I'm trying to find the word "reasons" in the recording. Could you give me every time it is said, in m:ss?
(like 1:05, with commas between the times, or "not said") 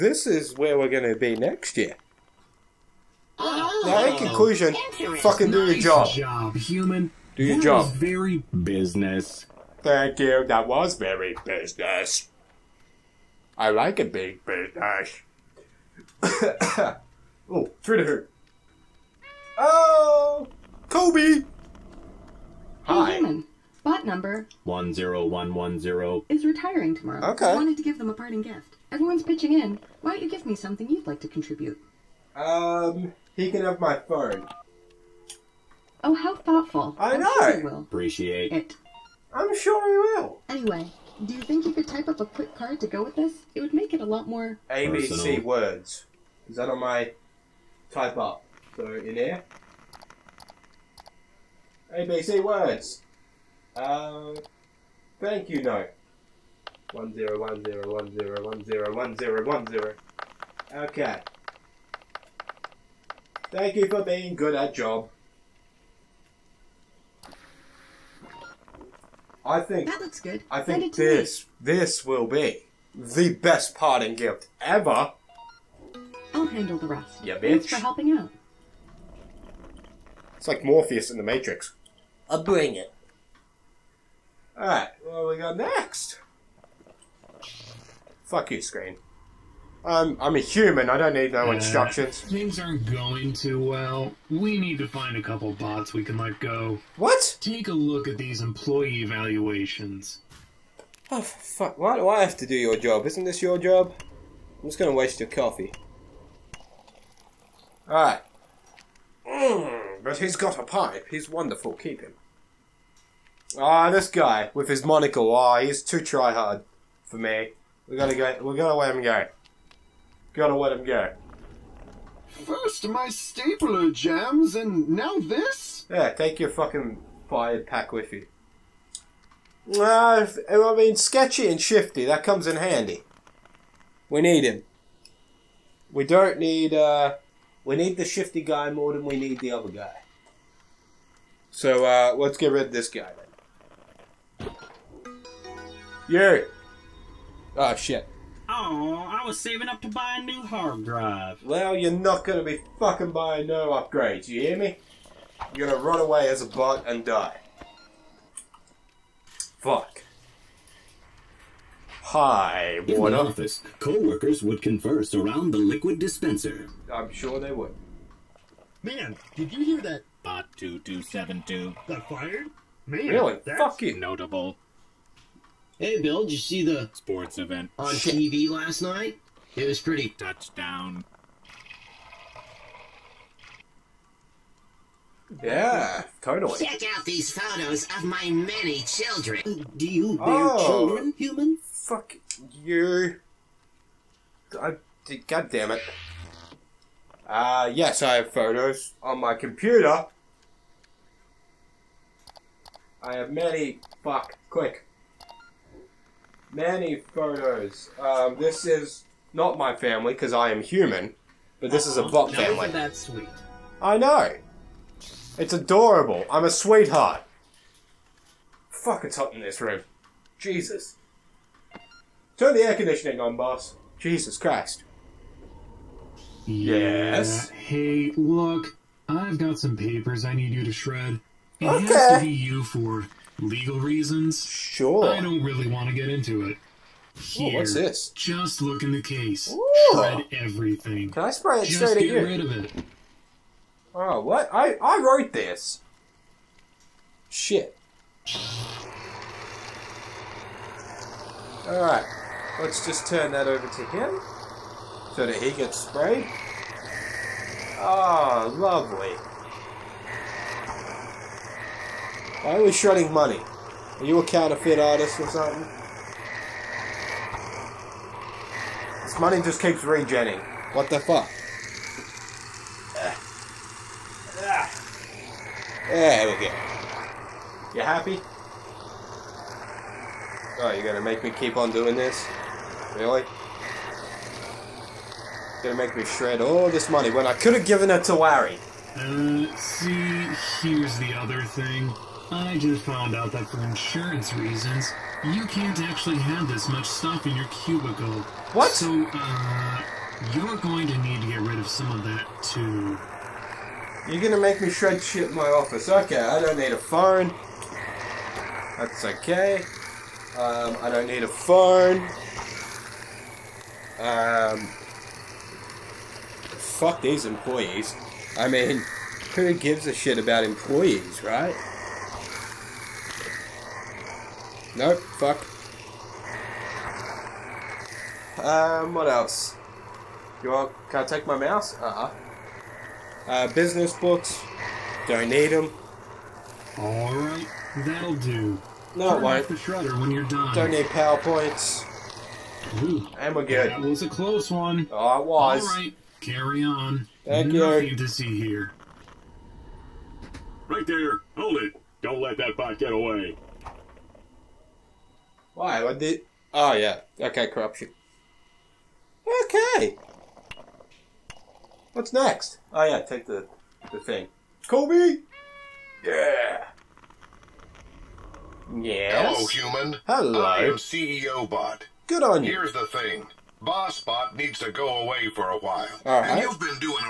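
3:53, 4:54.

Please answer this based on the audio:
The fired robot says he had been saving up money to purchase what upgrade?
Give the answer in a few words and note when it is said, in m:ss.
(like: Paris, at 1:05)
a new hard drive, at 2:30.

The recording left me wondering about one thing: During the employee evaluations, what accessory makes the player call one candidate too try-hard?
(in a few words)
monocle.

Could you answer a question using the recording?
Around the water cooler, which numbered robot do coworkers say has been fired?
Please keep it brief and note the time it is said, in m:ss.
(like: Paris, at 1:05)
Bot 2272, at 2:50.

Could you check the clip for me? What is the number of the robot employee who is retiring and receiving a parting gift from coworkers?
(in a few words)
10110.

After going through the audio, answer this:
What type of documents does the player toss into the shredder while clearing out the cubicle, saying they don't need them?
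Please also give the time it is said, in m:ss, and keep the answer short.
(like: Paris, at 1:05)
business books, at 5:33.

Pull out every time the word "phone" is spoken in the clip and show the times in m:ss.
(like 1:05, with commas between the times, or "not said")
0:33, 5:06, 5:11.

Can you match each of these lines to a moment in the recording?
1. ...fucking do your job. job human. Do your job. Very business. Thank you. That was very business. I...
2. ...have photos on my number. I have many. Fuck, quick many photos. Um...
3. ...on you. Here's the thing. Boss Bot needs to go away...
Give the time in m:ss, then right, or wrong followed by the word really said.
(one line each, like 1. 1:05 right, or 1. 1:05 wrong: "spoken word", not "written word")
1. 0:05 right
2. 3:18 wrong: "computer", not "number"
3. 6:12 right.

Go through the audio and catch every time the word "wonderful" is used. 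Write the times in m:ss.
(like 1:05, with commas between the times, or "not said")
1:51.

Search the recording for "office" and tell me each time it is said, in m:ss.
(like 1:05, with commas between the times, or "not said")
2:43, 5:05.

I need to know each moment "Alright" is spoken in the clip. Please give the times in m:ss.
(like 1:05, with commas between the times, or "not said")
1:47, 4:11, 5:36, 5:45.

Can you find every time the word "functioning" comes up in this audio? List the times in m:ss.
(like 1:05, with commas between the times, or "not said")
not said.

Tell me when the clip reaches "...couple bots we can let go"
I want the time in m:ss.
1:35.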